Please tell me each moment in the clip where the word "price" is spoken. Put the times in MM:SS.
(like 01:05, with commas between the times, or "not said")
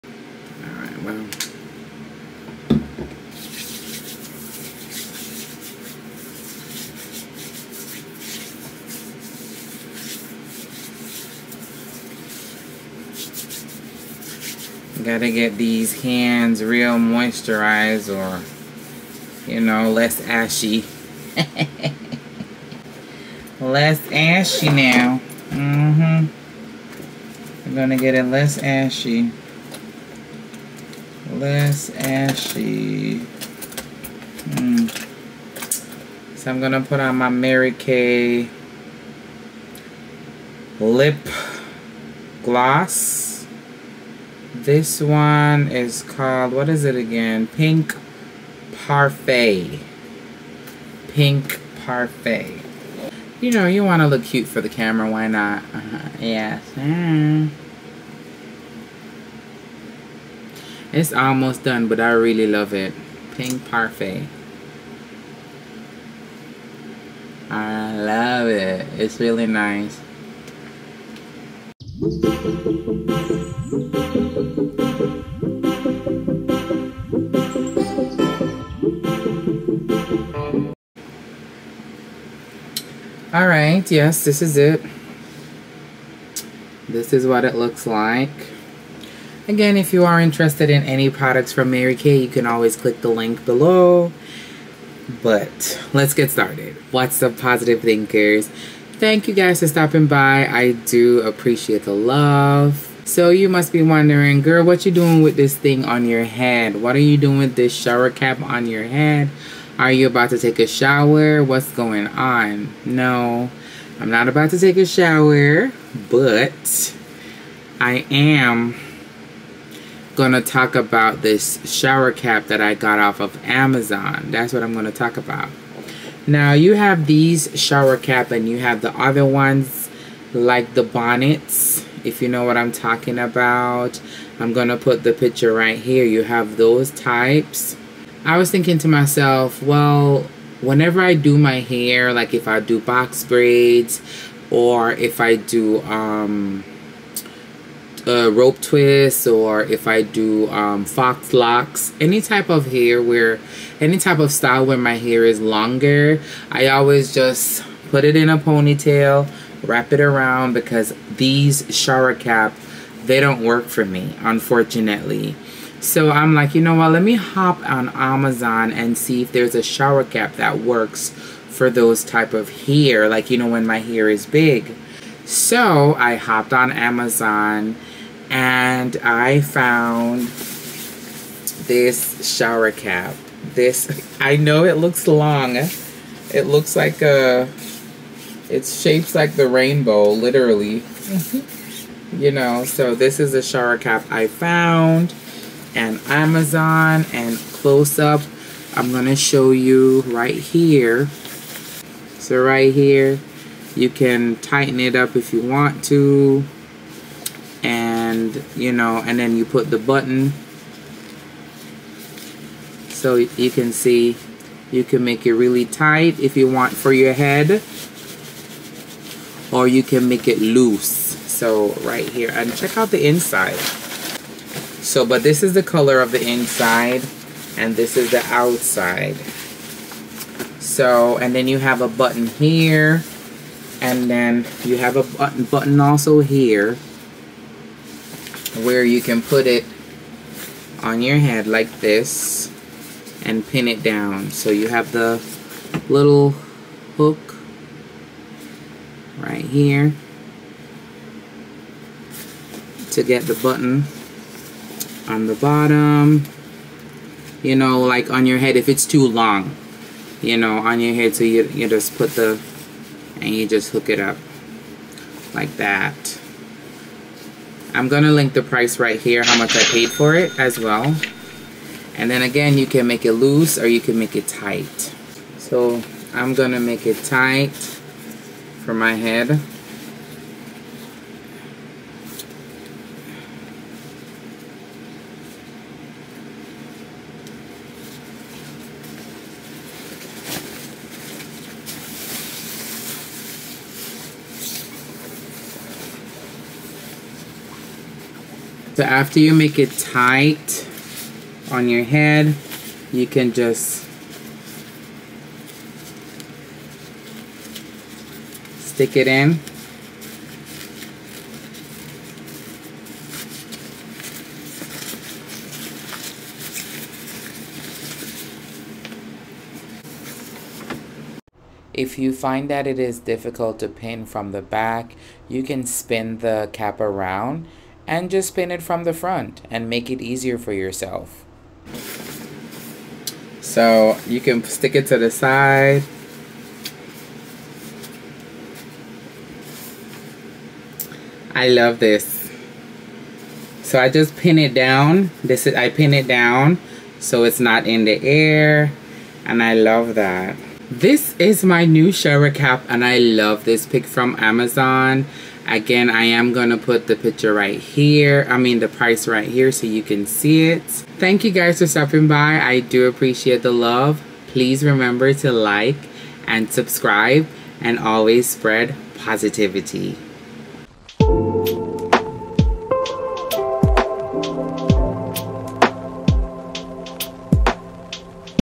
04:28, 05:58.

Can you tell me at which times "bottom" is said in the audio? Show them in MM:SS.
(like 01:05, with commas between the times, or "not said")
04:15.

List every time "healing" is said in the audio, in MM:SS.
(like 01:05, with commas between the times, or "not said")
not said.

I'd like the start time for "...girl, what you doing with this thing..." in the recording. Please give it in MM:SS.
01:44.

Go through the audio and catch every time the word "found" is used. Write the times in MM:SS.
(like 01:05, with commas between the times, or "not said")
02:59, 03:14.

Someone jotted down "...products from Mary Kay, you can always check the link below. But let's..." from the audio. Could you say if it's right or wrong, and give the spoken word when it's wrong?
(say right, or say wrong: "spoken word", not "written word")
wrong: "click", not "check".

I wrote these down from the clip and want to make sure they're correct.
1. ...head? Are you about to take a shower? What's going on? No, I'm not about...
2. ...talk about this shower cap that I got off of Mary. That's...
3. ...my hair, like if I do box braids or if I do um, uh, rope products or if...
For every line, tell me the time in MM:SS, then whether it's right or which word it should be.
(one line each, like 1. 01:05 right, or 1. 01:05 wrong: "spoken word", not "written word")
1. 01:48 right
2. 02:00 wrong: "Amazon", not "Mary"
3. 02:21 wrong: "twists", not "products".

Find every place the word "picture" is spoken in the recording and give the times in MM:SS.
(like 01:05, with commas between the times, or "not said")
02:15, 05:56.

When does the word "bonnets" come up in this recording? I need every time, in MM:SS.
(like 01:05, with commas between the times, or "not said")
02:10.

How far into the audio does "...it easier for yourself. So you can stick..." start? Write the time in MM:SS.
05:29.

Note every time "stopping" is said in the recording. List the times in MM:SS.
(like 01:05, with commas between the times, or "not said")
01:39, 06:01.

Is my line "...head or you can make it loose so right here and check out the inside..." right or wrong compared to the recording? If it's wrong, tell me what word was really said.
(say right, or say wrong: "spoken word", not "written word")
right.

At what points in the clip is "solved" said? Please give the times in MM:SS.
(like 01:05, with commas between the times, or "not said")
not said.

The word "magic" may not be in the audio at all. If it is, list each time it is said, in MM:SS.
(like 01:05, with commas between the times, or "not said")
not said.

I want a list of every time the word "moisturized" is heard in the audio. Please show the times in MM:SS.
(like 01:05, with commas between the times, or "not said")
00:16.